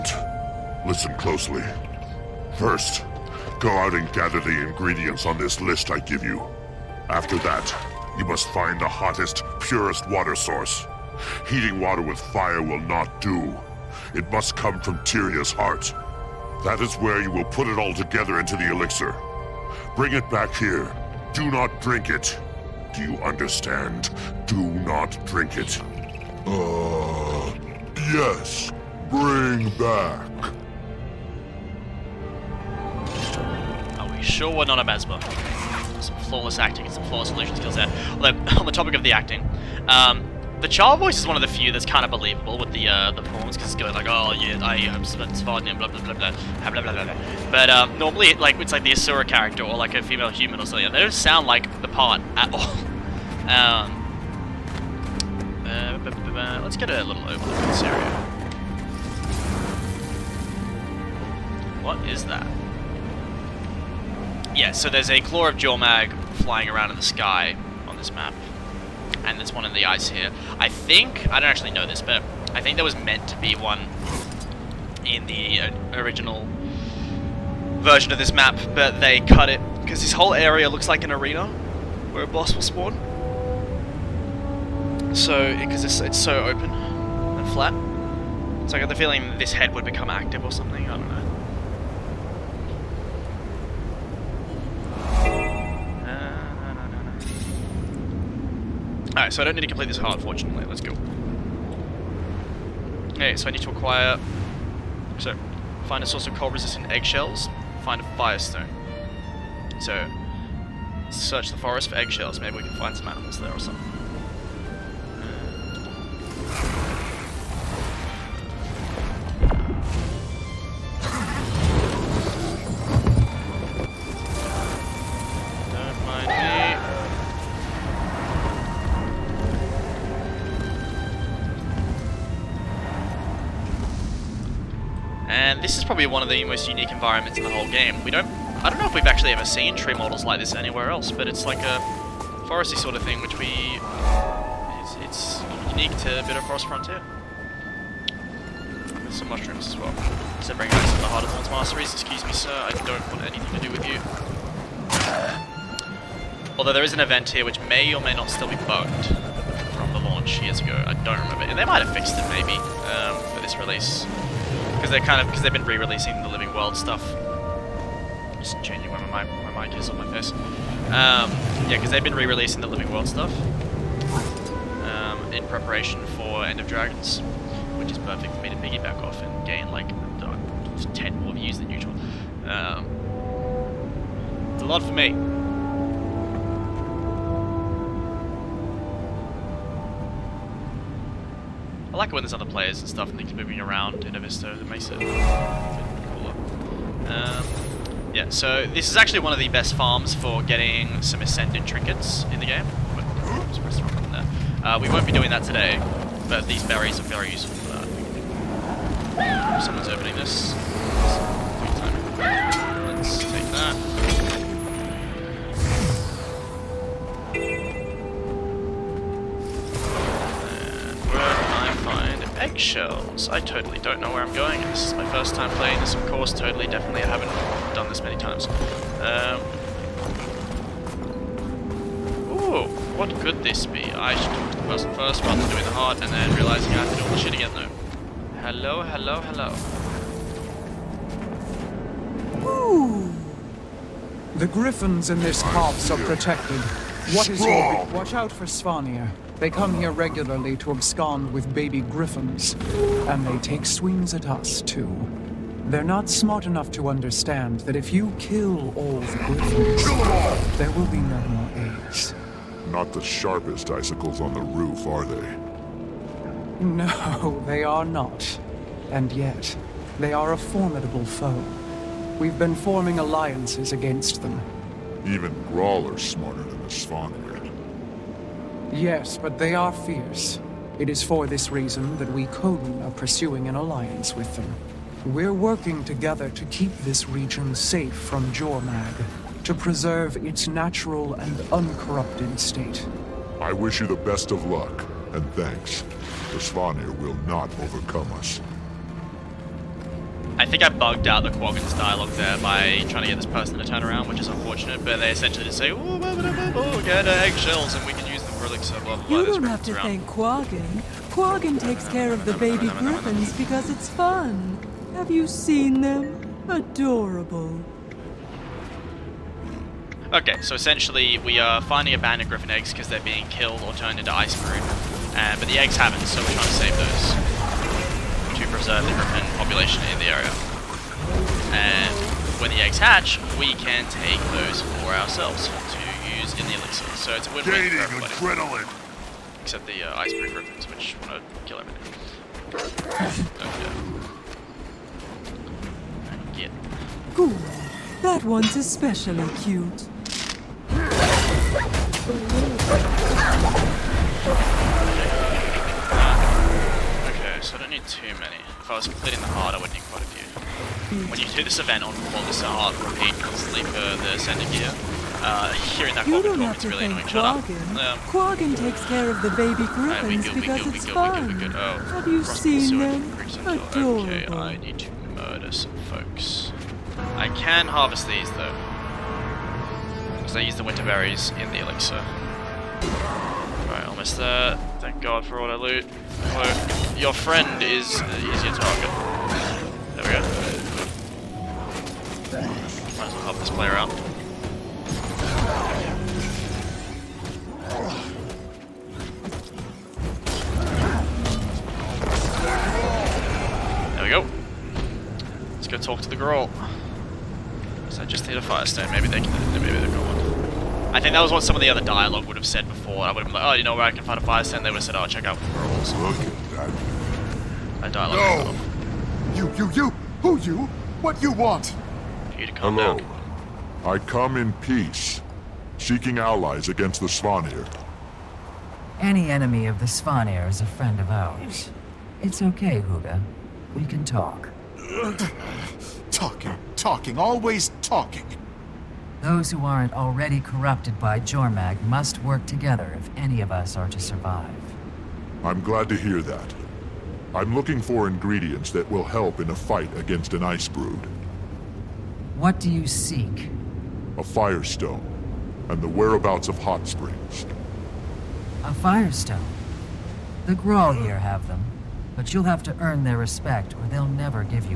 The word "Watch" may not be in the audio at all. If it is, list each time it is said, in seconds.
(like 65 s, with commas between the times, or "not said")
247 s.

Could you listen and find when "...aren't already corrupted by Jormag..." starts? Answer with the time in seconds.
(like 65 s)
439 s.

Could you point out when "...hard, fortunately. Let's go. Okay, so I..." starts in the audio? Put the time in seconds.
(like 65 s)
99 s.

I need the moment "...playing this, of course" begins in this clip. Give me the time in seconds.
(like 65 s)
225 s.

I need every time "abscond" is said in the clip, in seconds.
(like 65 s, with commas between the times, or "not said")
250 s.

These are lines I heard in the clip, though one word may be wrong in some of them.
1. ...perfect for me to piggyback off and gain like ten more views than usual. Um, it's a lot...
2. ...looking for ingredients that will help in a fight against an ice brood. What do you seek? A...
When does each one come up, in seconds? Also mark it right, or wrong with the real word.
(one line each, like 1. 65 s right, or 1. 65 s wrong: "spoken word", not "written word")
1. 177 s right
2. 447 s right.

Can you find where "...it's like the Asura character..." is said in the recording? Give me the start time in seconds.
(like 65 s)
48 s.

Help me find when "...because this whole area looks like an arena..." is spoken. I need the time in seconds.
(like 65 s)
79 s.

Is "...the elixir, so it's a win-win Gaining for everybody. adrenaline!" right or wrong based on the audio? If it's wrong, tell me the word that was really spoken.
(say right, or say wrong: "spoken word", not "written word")
right.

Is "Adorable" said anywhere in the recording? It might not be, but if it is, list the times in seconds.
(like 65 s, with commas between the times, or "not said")
316 s, 373 s.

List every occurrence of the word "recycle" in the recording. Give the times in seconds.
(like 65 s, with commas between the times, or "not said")
not said.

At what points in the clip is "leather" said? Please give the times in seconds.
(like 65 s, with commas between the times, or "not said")
not said.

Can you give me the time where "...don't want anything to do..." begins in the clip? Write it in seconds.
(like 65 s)
152 s.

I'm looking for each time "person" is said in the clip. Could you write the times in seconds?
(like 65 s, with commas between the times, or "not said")
234 s, 303 s.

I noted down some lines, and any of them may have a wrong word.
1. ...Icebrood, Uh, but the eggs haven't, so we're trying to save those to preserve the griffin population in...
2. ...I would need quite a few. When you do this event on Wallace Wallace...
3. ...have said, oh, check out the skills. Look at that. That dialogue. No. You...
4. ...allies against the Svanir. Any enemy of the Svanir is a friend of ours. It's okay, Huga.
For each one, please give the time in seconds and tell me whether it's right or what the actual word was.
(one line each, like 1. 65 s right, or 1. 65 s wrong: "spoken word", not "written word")
1. 324 s right
2. 359 s wrong: "Hard", not "Wallace"
3. 414 s wrong: "girls", not "skills"
4. 426 s right.